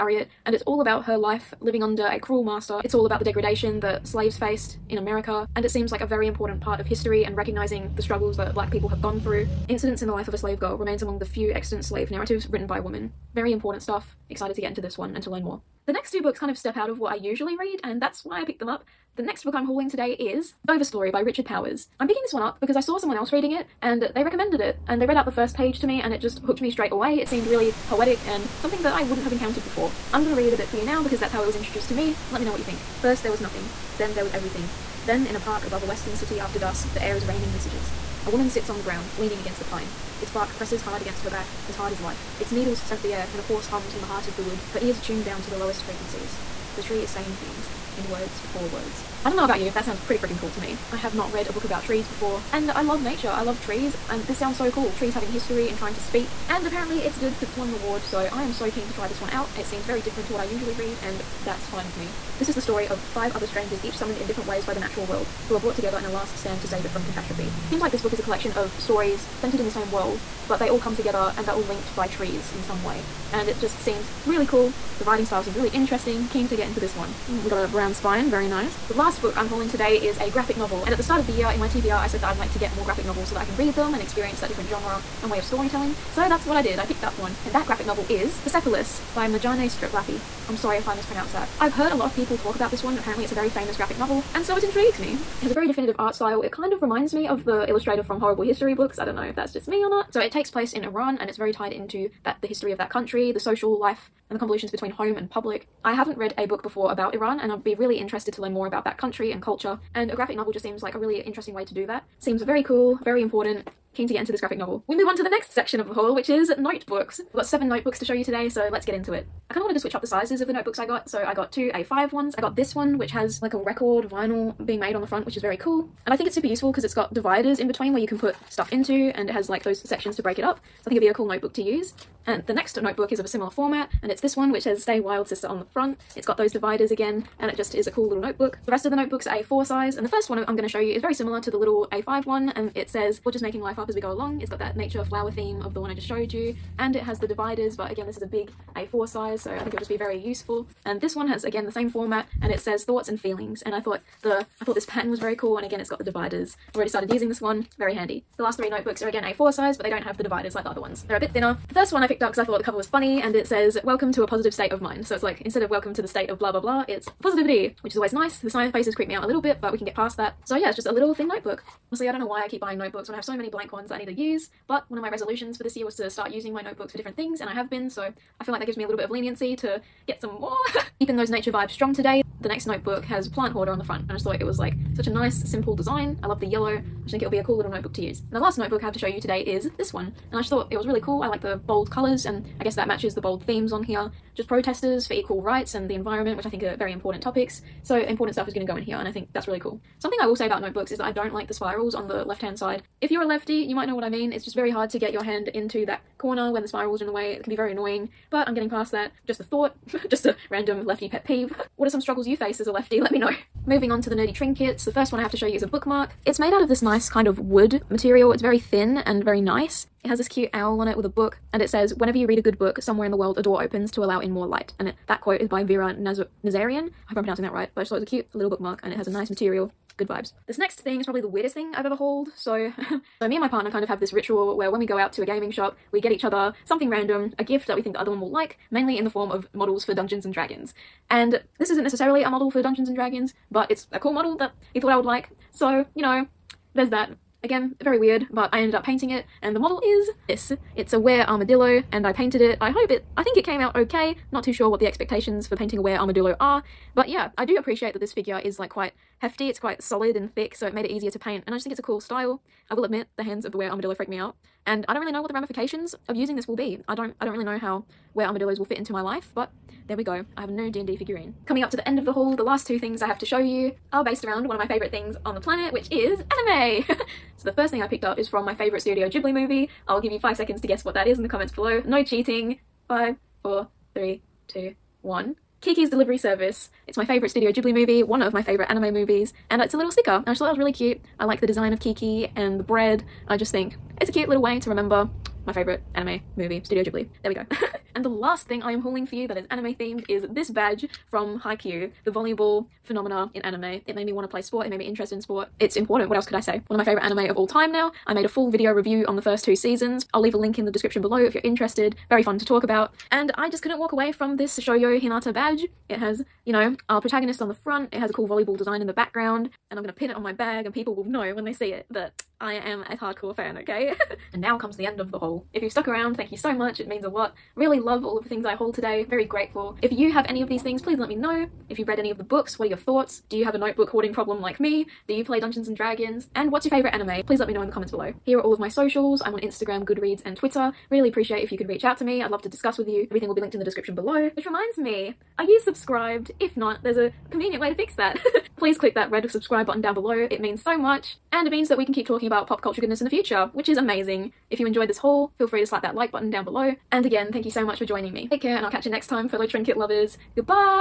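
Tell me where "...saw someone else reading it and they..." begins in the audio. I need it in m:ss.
0:22.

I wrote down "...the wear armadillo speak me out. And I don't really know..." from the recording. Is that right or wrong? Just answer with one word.
wrong.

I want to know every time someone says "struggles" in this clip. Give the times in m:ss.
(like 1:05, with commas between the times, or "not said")
0:08, 3:32.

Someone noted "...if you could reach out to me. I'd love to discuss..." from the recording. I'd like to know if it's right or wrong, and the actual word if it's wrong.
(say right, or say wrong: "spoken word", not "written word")
right.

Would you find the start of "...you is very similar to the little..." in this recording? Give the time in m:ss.
2:20.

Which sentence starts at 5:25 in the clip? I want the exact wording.
If you've stuck around, thank you so much, it means a lot.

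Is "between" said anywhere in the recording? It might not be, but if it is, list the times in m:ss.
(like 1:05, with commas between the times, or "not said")
1:44, 2:07.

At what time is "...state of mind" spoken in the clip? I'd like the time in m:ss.
2:44.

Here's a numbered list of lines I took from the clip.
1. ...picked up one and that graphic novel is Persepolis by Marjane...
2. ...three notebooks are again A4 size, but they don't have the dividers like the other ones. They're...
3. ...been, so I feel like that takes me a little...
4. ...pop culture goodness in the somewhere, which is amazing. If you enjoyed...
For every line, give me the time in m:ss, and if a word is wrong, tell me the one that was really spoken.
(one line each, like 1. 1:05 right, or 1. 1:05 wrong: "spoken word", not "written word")
1. 1:26 right
2. 2:38 right
3. 2:57 wrong: "gives", not "takes"
4. 5:52 wrong: "future", not "somewhere".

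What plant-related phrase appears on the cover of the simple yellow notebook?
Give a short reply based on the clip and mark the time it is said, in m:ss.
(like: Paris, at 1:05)
plant hoarder, at 3:03.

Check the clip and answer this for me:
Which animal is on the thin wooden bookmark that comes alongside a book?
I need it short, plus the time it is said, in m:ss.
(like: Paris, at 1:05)
owl, at 3:40.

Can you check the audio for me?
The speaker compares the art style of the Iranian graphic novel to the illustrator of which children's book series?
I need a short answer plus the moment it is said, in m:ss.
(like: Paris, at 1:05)
Horrible History, at 1:38.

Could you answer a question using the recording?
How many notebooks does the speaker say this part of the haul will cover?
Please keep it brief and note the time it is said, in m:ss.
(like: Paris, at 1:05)
7, at 1:57.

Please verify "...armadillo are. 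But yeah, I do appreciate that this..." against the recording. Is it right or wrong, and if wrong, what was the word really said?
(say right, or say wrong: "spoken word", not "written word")
right.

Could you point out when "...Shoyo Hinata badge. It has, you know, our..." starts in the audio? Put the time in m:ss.
5:14.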